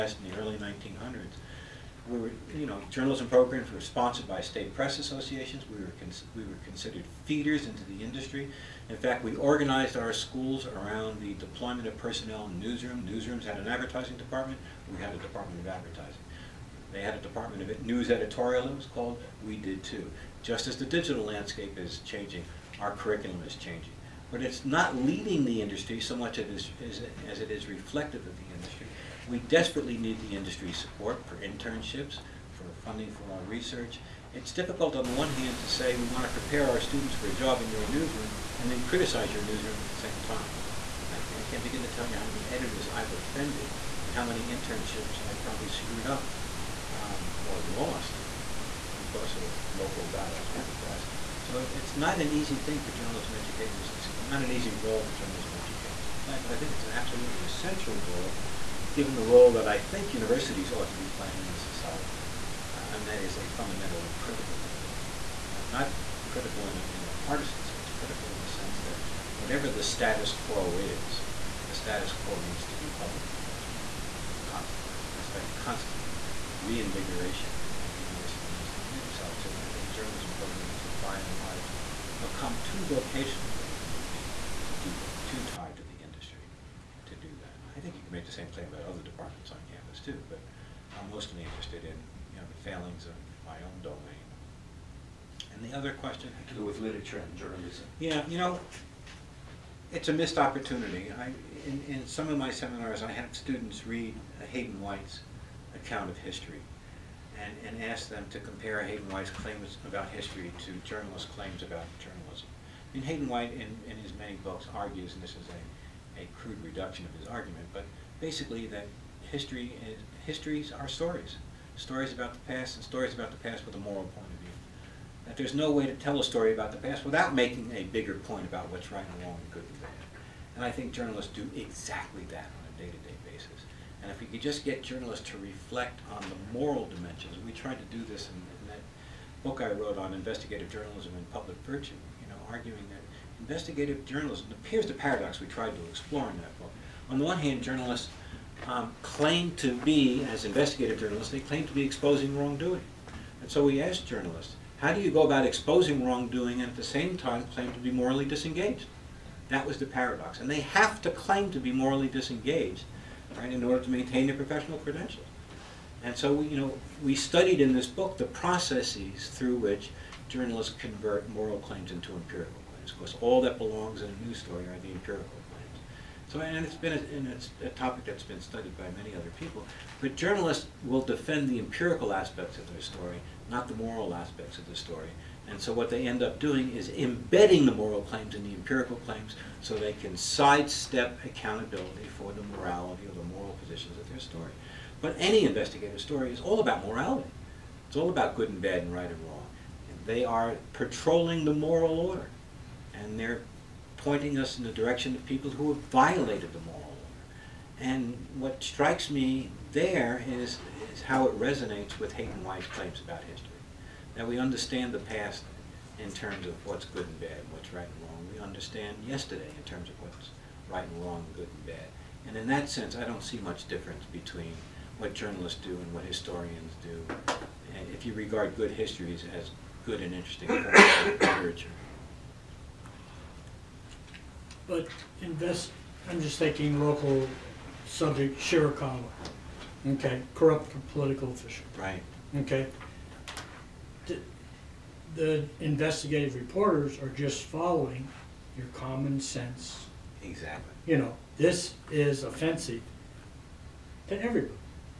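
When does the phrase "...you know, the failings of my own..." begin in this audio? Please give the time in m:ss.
1:32.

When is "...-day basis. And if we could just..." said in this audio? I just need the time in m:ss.
2:13.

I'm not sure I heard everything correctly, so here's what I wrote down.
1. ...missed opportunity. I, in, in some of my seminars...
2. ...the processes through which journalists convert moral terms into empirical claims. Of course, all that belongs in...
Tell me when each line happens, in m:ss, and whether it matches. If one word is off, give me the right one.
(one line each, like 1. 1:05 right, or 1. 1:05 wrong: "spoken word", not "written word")
1. 1:40 right
2. 2:48 wrong: "claims", not "terms".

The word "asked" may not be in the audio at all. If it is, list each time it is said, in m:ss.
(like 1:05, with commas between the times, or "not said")
2:33.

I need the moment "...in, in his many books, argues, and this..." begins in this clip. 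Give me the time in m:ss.
1:53.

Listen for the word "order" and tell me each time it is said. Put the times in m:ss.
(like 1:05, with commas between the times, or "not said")
2:43, 3:21, 3:26.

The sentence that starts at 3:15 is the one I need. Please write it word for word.
But any investigative story is all about morality.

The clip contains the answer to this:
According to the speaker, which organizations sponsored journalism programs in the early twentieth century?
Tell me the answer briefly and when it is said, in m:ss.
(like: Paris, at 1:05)
state press associations, at 0:04.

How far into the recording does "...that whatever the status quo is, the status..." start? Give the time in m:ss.
1:08.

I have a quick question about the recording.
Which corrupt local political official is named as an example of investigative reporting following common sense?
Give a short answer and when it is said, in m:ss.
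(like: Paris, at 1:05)
Shirakawa, at 3:58.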